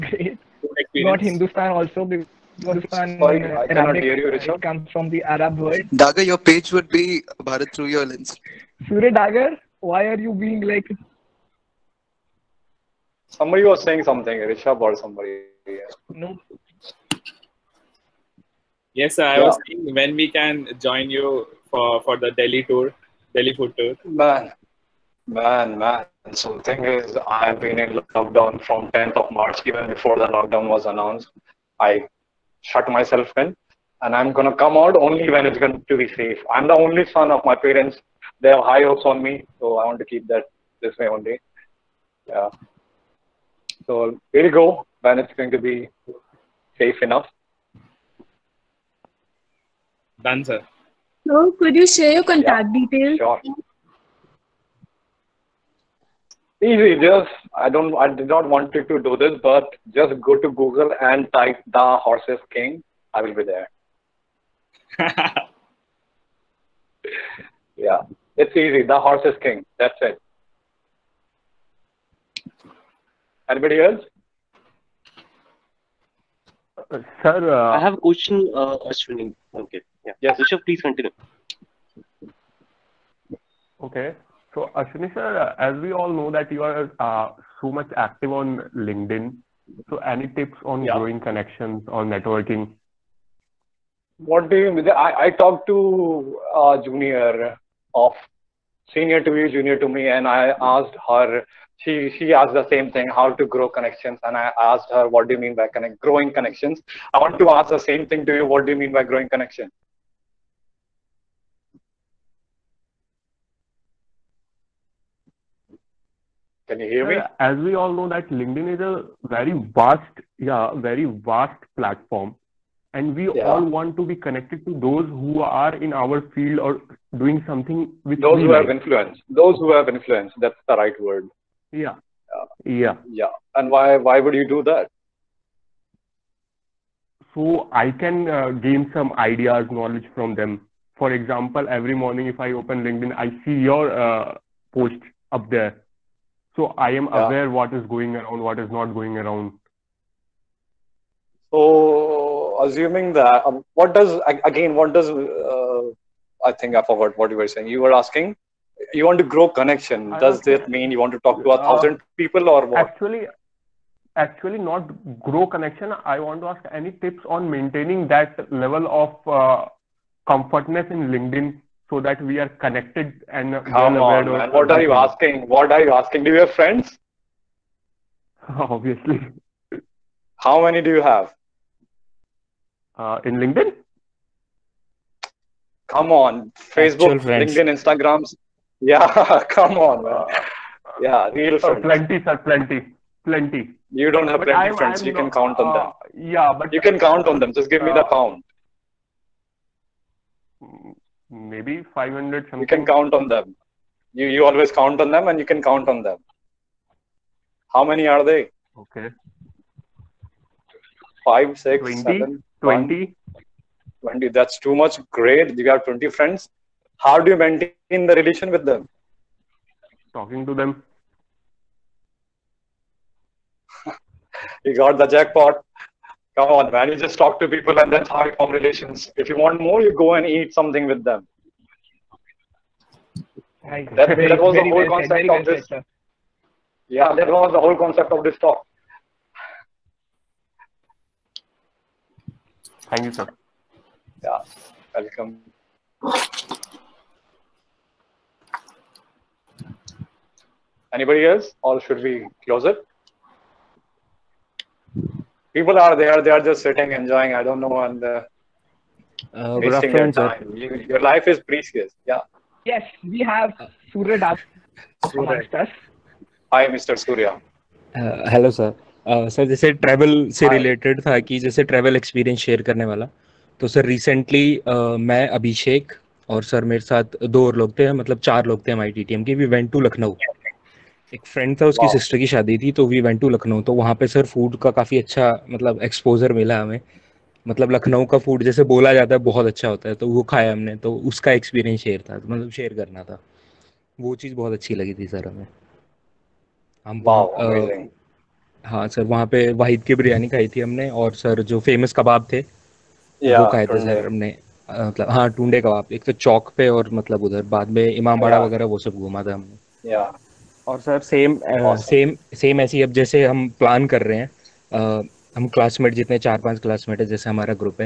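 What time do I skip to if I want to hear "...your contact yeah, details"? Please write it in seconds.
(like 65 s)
52 s.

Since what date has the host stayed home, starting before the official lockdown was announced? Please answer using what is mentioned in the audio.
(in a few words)
10th of March.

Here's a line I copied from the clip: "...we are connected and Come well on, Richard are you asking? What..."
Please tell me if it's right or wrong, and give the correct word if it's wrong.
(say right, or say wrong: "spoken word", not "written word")
wrong: "What", not "Richard".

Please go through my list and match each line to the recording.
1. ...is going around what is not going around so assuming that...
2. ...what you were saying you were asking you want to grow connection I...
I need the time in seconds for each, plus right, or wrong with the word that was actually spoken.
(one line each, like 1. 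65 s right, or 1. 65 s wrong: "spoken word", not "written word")
1. 147 s right
2. 157 s right.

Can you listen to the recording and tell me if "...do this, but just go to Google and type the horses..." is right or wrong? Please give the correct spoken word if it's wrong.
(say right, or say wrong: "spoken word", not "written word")
right.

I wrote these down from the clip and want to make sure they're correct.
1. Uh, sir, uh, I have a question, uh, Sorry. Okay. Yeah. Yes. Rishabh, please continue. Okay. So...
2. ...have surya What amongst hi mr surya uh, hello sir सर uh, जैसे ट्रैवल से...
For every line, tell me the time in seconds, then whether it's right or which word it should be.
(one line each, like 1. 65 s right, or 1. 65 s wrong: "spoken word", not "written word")
1. 76 s wrong: "Ashwani", not "Sorry"
2. 263 s wrong: "Das", not "What".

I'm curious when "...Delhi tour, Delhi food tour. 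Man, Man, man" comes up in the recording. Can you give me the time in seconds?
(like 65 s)
22 s.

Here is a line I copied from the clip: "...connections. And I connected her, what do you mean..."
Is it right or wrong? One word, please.
wrong.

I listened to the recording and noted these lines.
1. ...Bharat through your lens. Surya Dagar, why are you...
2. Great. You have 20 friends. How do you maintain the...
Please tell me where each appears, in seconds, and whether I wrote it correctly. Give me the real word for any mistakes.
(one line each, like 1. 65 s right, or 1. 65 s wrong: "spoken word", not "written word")
1. 7 s right
2. 215 s right.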